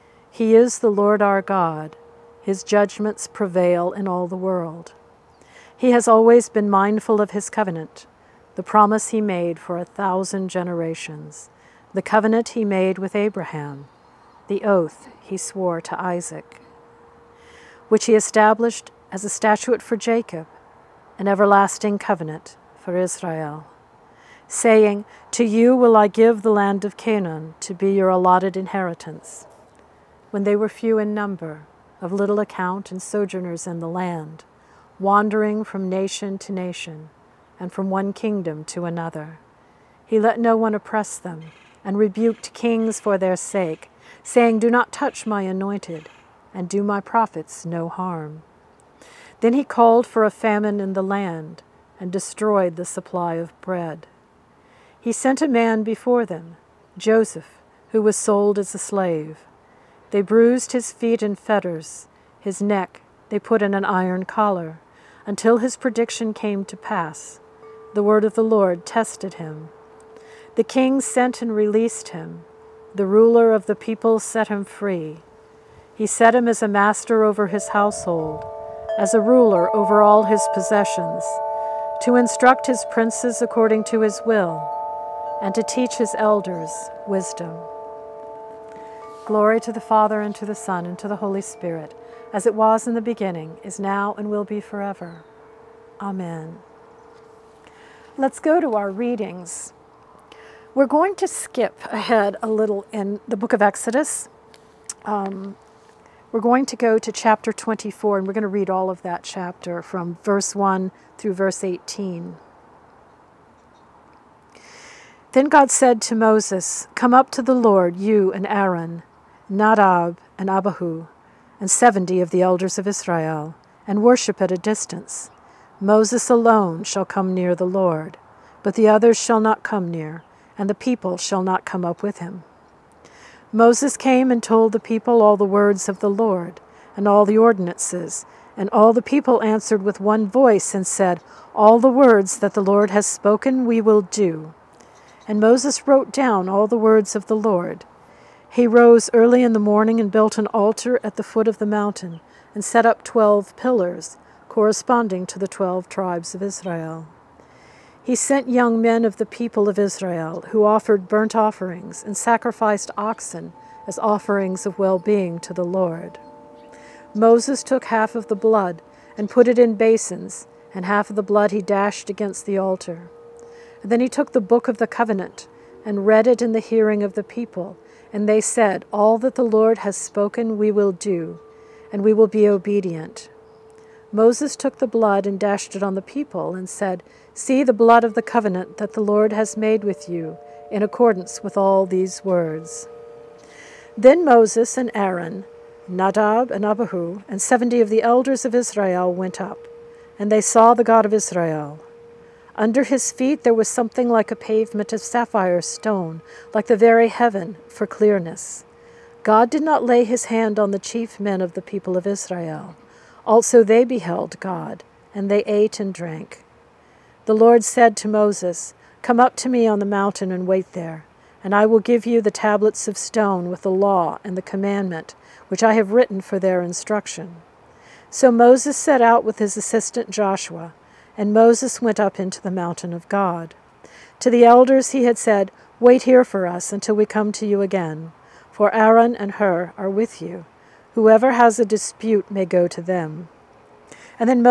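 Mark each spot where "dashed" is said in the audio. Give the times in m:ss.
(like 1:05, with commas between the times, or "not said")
2:51, 3:05.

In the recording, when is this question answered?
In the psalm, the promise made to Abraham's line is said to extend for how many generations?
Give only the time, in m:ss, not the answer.
0:09.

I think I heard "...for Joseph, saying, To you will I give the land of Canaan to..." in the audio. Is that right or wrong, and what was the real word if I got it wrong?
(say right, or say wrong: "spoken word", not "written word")
wrong: "Israel", not "Joseph".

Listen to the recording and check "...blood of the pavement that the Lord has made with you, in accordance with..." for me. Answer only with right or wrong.
wrong.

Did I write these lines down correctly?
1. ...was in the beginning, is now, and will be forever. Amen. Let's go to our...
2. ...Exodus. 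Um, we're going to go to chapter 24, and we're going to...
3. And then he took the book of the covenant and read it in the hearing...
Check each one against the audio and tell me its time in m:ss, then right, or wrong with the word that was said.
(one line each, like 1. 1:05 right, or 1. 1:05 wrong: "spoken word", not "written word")
1. 1:32 right
2. 1:43 right
3. 2:53 right.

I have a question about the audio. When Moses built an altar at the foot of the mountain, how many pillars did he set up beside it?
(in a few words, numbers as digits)
12.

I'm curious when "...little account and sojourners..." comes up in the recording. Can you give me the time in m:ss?
0:32.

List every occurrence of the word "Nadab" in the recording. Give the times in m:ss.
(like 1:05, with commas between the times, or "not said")
1:59, 3:15.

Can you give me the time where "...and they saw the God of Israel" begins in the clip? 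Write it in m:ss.
3:20.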